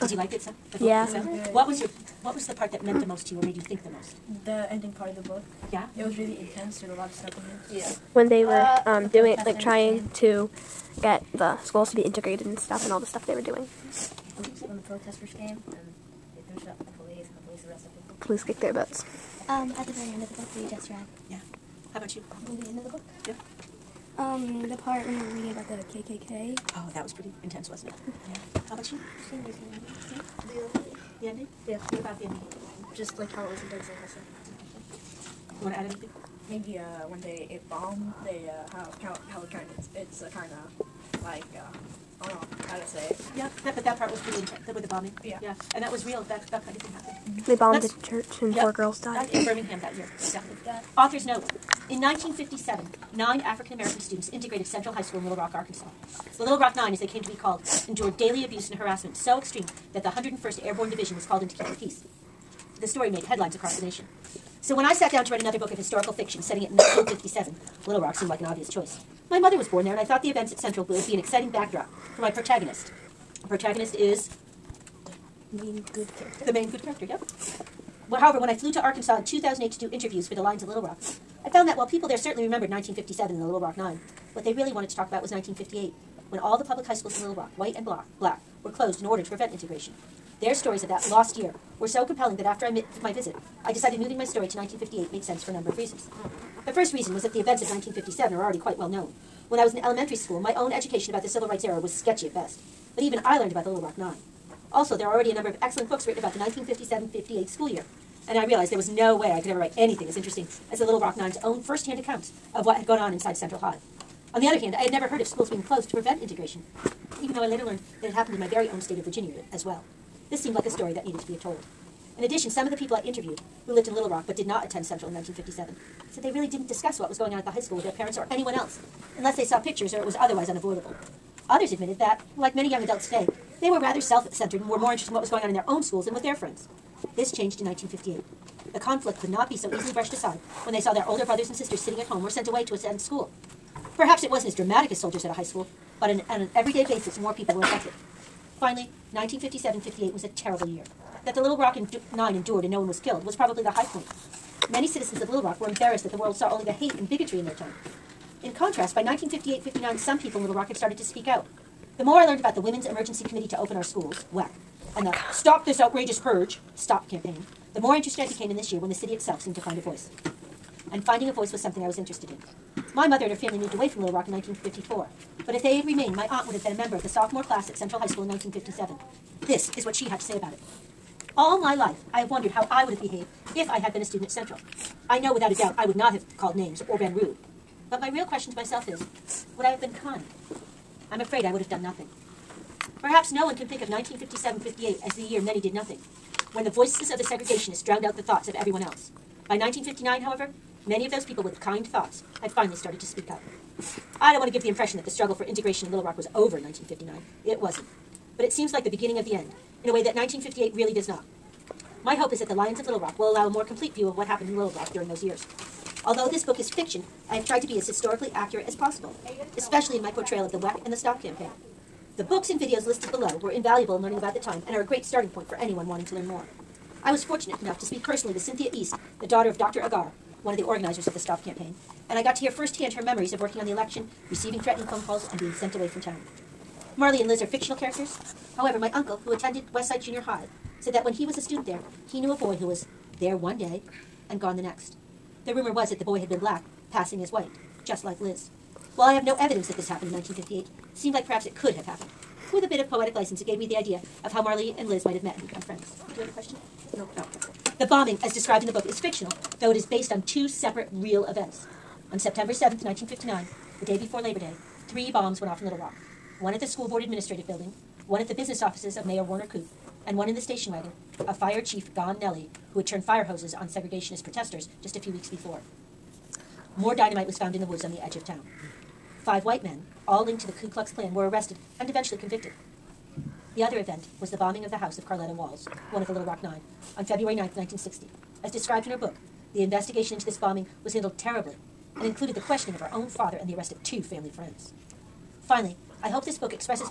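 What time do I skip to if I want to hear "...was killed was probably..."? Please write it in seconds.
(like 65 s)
152 s.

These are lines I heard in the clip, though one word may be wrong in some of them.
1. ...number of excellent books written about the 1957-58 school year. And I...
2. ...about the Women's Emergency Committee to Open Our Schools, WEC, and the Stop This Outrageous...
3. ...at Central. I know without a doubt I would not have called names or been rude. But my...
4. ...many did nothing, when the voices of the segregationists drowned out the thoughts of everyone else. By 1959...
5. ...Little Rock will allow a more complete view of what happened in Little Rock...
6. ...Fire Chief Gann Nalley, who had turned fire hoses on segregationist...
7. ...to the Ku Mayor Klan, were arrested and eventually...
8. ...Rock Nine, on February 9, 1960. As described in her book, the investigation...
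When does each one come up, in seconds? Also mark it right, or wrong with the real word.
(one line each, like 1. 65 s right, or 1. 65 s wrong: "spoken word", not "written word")
1. 105 s right
2. 162 s right
3. 184 s right
4. 195 s right
5. 212 s right
6. 271 s right
7. 280 s wrong: "Klux", not "Mayor"
8. 286 s right.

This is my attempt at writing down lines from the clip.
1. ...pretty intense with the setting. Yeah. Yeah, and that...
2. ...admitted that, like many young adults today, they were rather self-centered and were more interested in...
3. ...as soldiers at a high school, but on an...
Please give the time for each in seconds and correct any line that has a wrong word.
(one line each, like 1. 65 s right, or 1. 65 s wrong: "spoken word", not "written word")
1. 44 s wrong: "bombing", not "setting"
2. 131 s right
3. 144 s right.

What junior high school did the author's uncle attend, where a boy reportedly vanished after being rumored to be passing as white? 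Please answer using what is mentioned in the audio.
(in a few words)
Westside Junior High.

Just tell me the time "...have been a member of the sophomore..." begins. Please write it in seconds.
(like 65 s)
176 s.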